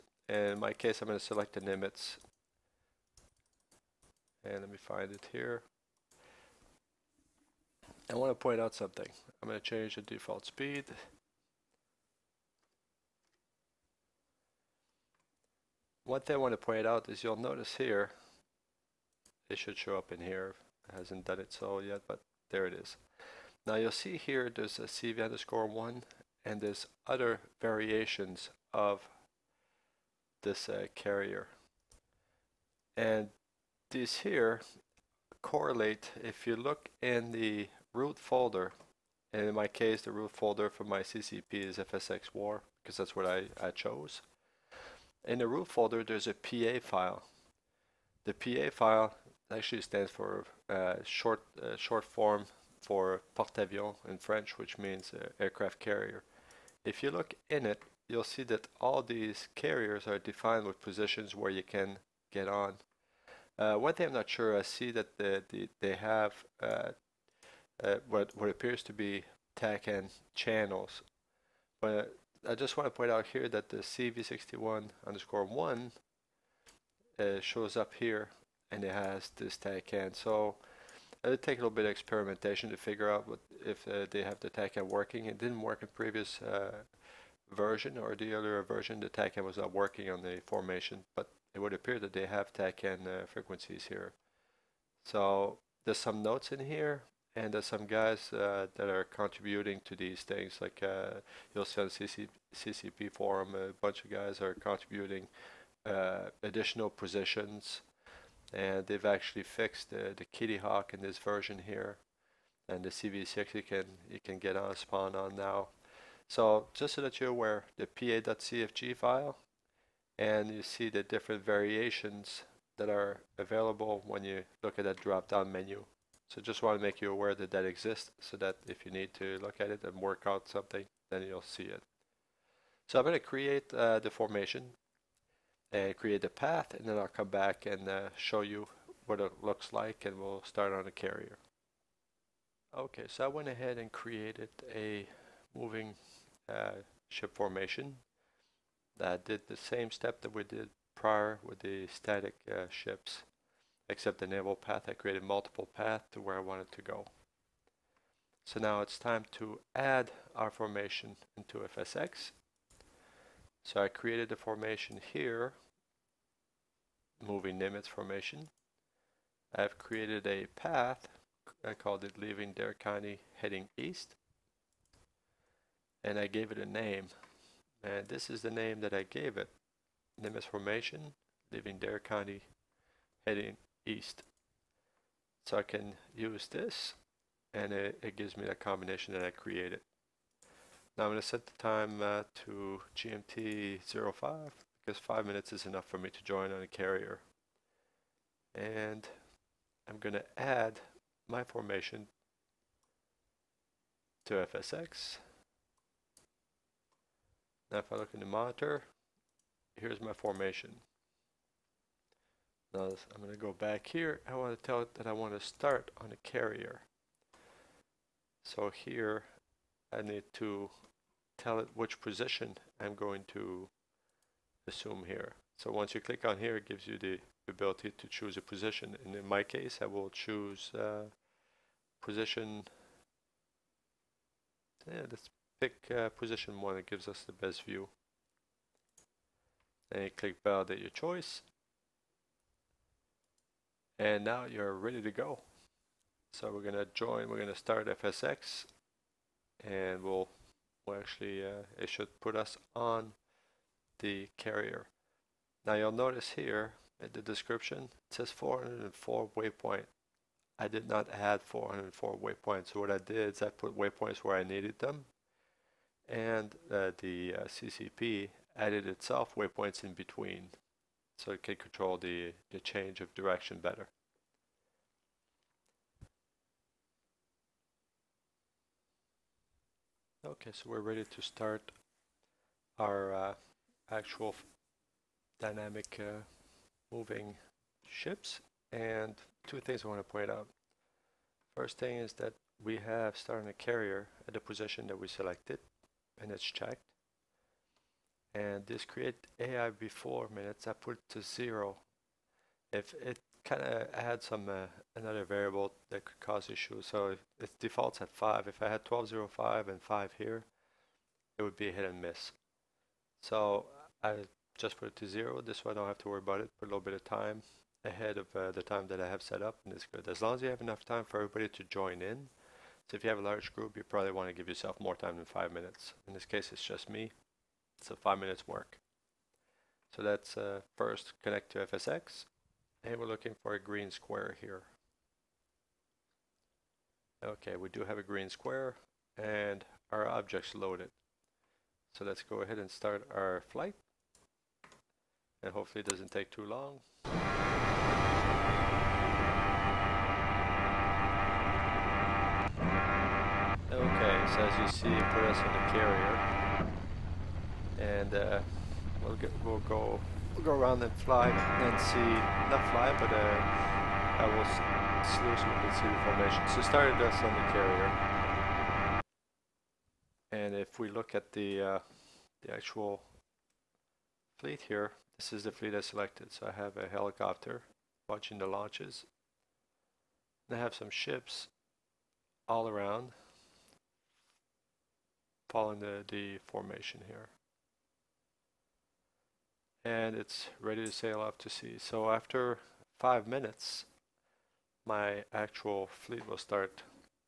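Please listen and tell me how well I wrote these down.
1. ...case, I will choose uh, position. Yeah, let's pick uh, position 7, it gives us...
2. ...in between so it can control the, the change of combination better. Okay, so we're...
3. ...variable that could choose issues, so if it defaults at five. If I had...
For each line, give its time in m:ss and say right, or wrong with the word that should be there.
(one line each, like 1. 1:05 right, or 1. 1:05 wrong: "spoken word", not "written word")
1. 3:49 wrong: "1", not "7"
2. 4:29 wrong: "direction", not "combination"
3. 5:05 wrong: "cause", not "choose".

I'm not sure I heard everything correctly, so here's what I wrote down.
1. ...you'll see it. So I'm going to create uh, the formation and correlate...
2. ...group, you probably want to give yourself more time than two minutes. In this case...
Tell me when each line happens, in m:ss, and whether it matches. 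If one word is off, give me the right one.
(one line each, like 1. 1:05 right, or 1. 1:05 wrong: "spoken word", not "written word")
1. 2:11 wrong: "create", not "correlate"
2. 5:23 wrong: "five", not "two".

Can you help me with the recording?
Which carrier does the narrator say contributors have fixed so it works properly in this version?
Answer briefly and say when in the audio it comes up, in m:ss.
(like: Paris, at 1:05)
Kitty Hawk, at 1:50.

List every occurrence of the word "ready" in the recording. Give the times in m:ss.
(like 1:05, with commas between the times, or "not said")
4:04, 4:40, 6:30.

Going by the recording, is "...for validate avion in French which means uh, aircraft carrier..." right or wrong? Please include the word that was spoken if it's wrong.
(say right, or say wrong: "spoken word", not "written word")
wrong: "porte", not "validate".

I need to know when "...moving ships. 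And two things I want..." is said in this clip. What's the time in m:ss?
4:46.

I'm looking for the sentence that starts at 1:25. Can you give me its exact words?
It didn't work in previous uh, version or the earlier version.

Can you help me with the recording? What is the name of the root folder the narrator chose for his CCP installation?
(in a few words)
FSX war.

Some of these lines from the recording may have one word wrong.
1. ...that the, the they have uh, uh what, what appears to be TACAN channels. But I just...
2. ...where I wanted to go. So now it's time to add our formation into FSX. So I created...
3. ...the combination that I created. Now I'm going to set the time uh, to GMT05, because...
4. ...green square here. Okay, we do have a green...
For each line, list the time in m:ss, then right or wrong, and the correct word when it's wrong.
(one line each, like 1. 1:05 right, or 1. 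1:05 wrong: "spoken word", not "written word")
1. 1:04 right
2. 2:36 right
3. 3:08 right
4. 5:33 right.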